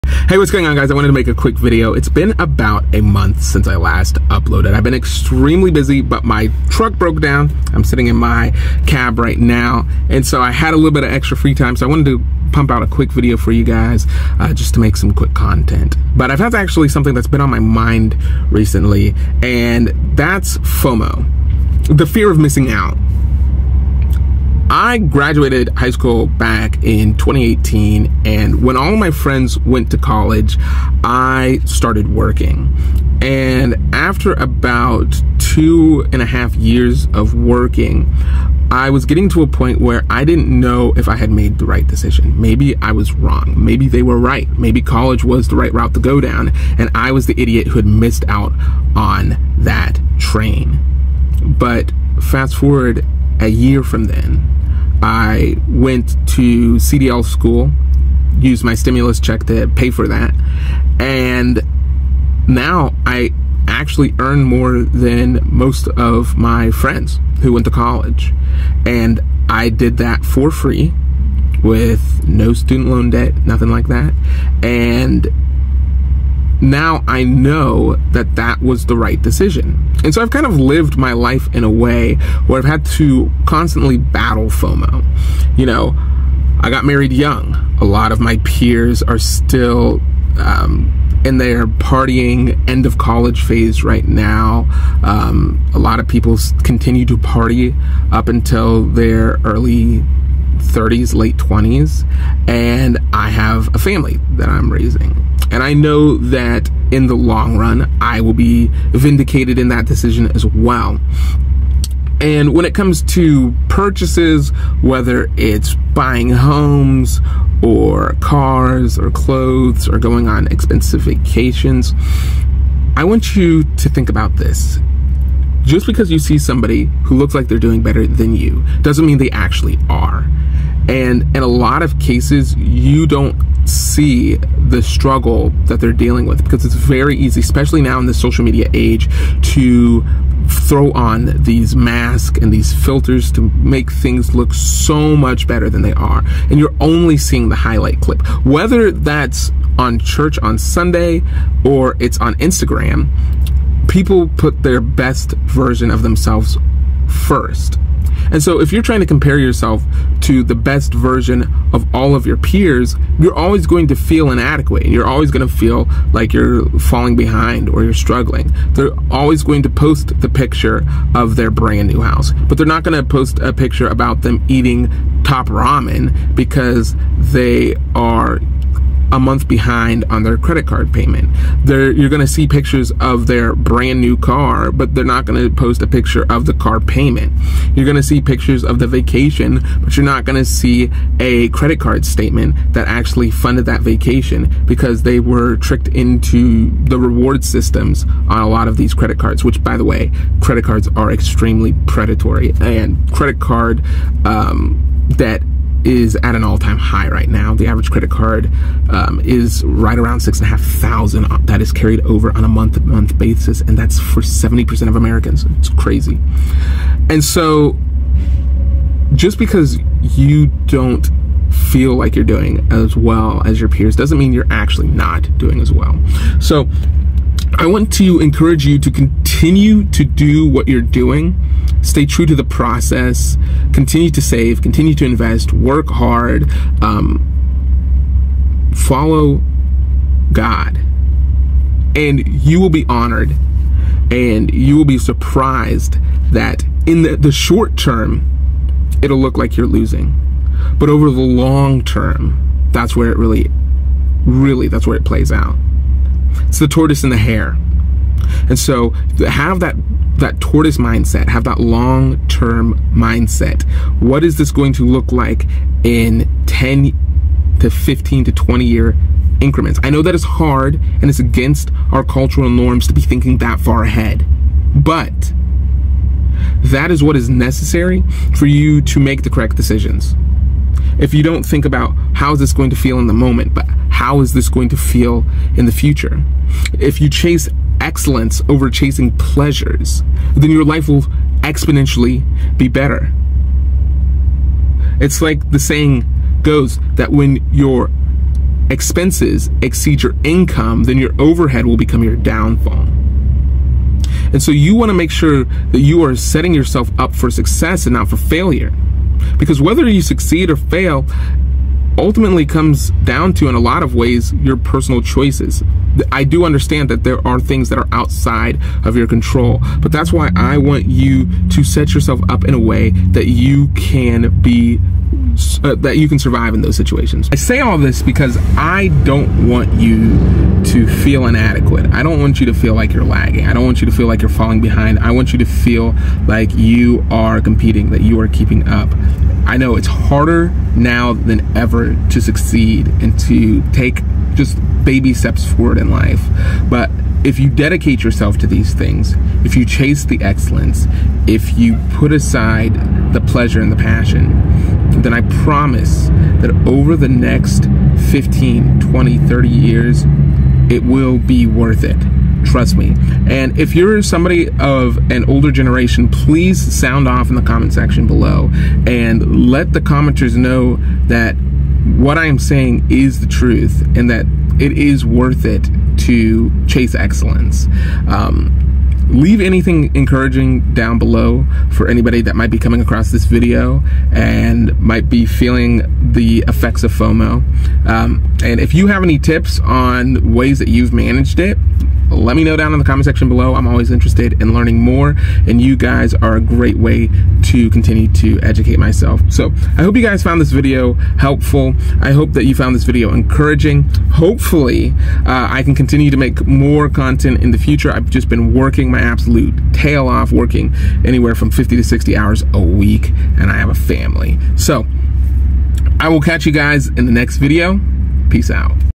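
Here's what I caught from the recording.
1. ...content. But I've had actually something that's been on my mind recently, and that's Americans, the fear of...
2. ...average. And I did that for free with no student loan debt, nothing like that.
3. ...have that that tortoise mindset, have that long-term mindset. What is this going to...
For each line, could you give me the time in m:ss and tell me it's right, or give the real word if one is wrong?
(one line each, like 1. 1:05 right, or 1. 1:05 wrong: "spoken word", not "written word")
1. 0:15 wrong: "FOMO", not "Americans"
2. 1:07 wrong: "college", not "average"
3. 4:19 right.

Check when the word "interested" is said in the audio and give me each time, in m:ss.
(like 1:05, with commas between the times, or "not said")
6:33.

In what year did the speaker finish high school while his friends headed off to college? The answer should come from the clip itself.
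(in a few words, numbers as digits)
2018.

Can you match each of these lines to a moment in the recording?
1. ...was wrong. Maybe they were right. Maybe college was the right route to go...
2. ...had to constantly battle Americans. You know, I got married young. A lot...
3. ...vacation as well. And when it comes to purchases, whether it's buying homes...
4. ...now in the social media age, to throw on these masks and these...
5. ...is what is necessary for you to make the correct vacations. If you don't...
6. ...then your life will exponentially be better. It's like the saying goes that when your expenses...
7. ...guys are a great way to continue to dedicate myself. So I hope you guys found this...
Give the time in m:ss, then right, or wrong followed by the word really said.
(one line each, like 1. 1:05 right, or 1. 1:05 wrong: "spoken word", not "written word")
1. 0:42 right
2. 1:22 wrong: "FOMO", not "Americans"
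3. 1:49 wrong: "decision", not "vacation"
4. 2:17 right
5. 4:36 wrong: "decisions", not "vacations"
6. 4:50 right
7. 6:35 wrong: "educate", not "dedicate".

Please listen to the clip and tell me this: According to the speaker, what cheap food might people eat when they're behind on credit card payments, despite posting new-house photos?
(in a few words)
Top ramen.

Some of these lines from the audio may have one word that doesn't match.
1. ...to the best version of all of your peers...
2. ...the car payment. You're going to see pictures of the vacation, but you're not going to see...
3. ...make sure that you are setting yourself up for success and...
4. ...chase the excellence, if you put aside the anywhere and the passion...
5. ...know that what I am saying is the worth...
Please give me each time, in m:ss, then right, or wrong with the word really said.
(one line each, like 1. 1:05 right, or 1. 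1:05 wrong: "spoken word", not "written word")
1. 2:40 right
2. 3:06 right
3. 5:04 right
4. 5:49 wrong: "pleasure", not "anywhere"
5. 6:10 wrong: "truth", not "worth".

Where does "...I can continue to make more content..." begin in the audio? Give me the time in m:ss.
6:45.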